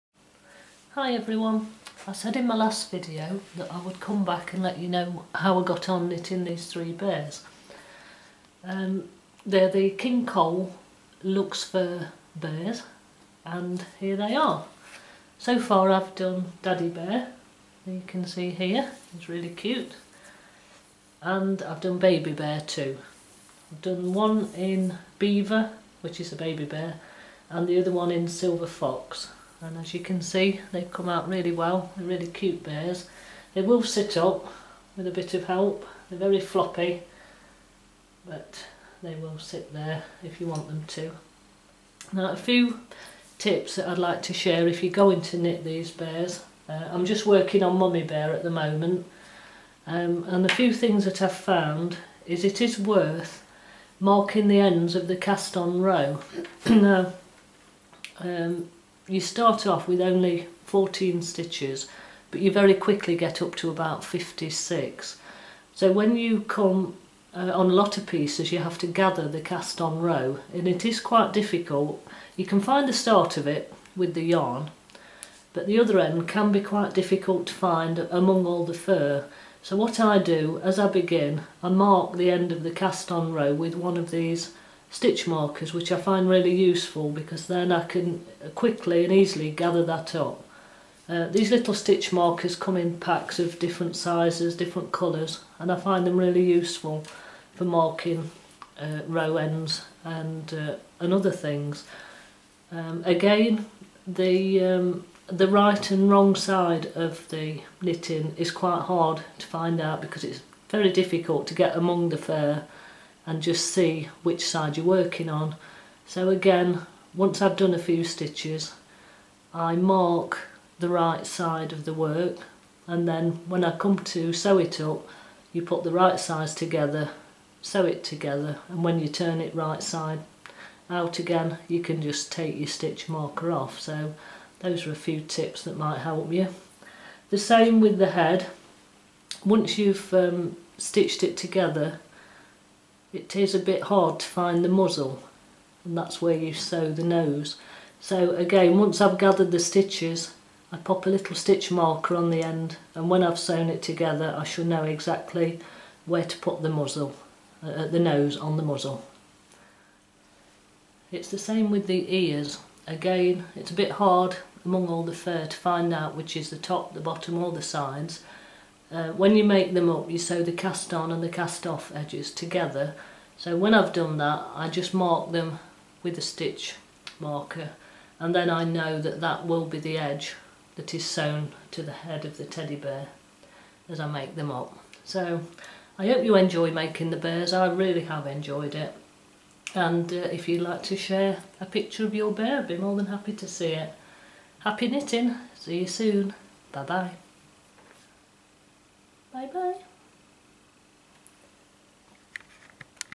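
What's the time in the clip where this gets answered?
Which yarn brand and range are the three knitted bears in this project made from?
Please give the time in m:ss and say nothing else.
0:09.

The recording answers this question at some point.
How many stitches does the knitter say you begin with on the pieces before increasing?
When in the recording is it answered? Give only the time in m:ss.
1:00.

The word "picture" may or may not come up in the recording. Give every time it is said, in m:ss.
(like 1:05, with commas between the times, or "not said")
3:11.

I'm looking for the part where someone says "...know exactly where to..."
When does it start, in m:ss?
2:34.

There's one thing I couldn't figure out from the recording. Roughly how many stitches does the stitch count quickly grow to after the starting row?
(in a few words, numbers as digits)
56.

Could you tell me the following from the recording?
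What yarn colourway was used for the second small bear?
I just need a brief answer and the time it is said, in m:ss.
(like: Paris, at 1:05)
Silver Fox, at 0:28.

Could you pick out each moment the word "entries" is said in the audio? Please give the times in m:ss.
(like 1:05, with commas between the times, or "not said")
not said.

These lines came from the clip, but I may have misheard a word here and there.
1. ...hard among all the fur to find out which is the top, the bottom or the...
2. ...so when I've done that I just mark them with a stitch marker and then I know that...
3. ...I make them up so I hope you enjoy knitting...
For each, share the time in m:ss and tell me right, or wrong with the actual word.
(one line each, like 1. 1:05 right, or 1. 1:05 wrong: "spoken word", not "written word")
1. 2:43 right
2. 2:53 right
3. 3:04 wrong: "making", not "knitting".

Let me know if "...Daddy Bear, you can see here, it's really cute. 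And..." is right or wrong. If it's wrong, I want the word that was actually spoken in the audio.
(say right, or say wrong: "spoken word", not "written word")
right.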